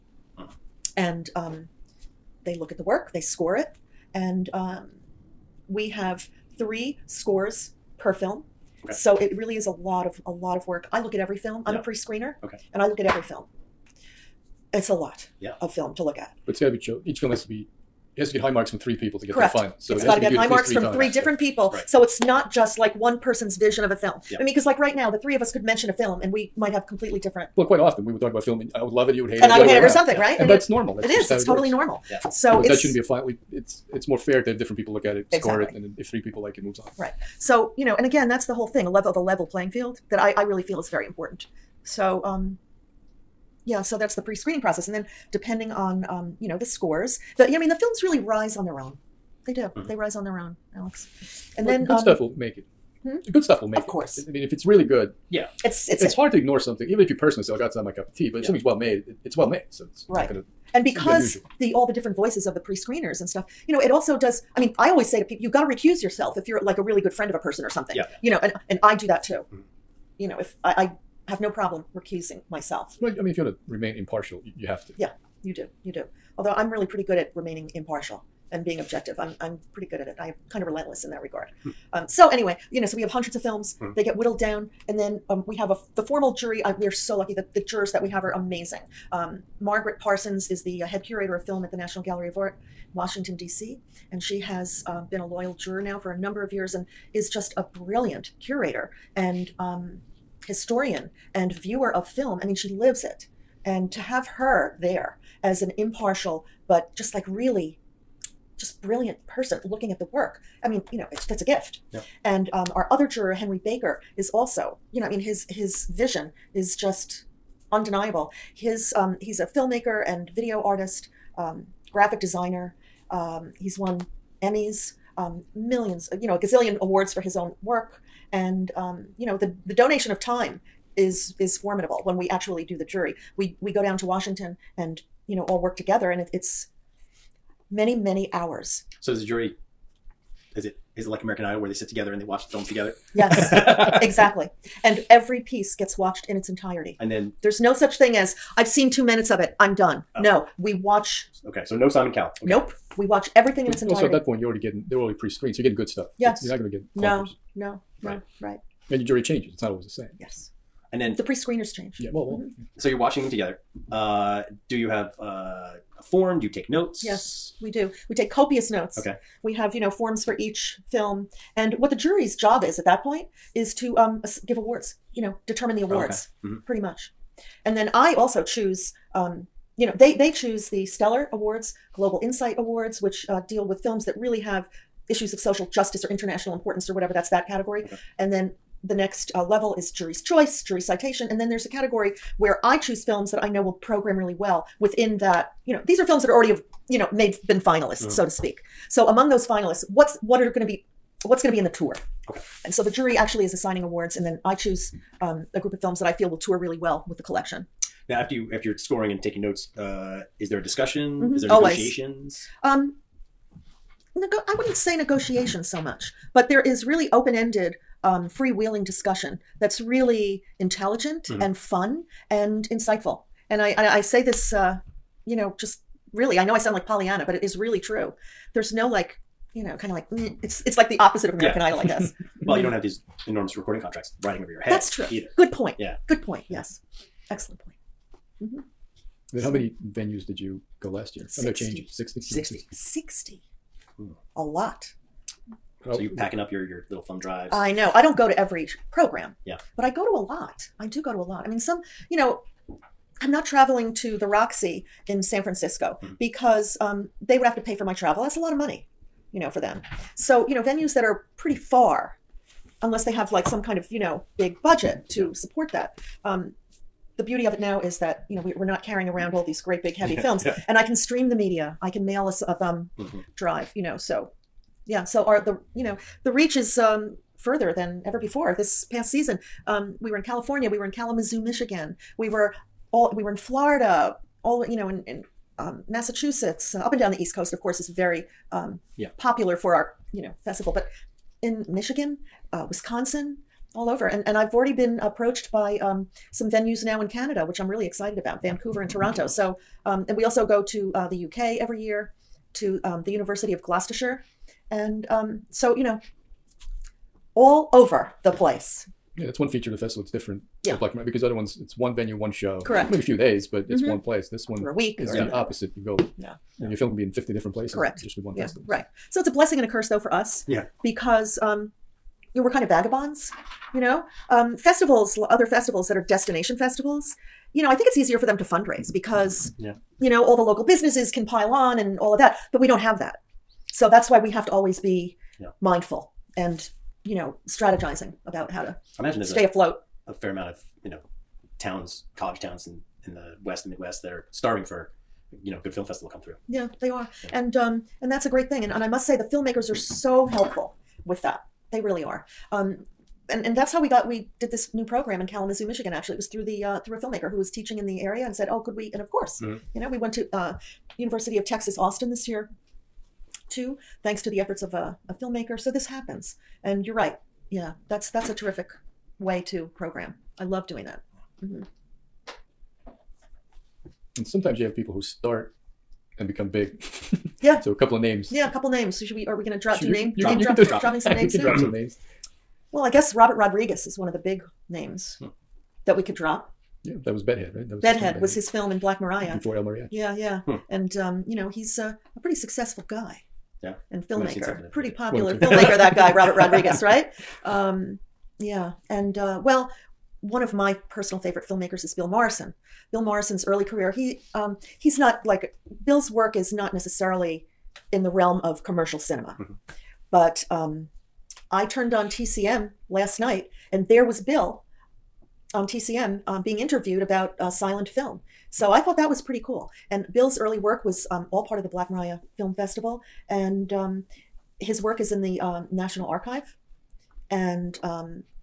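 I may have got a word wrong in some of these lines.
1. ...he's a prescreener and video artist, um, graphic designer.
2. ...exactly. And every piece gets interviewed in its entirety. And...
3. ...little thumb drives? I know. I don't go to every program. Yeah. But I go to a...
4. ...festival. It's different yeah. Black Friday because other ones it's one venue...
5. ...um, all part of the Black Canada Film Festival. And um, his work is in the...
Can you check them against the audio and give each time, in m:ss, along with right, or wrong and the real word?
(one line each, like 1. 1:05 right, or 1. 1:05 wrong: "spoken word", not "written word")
1. 1:59 wrong: "filmmaker", not "prescreener"
2. 2:24 wrong: "watched", not "interviewed"
3. 4:06 right
4. 5:09 right
5. 7:01 wrong: "Maria", not "Canada".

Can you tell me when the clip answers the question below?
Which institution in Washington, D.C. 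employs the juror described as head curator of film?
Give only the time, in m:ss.
1:31.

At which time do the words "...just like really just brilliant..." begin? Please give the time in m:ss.
1:46.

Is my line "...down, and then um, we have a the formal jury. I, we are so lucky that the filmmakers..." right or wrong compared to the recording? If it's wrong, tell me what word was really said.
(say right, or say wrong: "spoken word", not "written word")
wrong: "jurors", not "filmmakers".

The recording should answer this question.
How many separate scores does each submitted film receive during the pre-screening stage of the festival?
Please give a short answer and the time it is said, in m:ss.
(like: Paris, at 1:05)
3, at 0:06.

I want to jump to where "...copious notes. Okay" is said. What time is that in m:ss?
2:48.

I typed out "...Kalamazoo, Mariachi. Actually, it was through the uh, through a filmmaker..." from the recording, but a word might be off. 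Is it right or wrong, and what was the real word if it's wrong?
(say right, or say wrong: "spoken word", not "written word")
wrong: "Michigan", not "Mariachi".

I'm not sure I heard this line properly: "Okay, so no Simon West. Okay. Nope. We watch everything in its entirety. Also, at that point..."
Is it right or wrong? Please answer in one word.
wrong.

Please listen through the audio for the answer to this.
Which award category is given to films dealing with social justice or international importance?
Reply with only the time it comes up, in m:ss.
3:01.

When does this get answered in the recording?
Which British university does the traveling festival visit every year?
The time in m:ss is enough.
5:03.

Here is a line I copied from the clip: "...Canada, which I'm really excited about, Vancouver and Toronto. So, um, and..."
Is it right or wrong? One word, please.
right.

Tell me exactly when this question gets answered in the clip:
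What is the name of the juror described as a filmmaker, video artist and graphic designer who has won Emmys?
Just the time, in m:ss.
1:53.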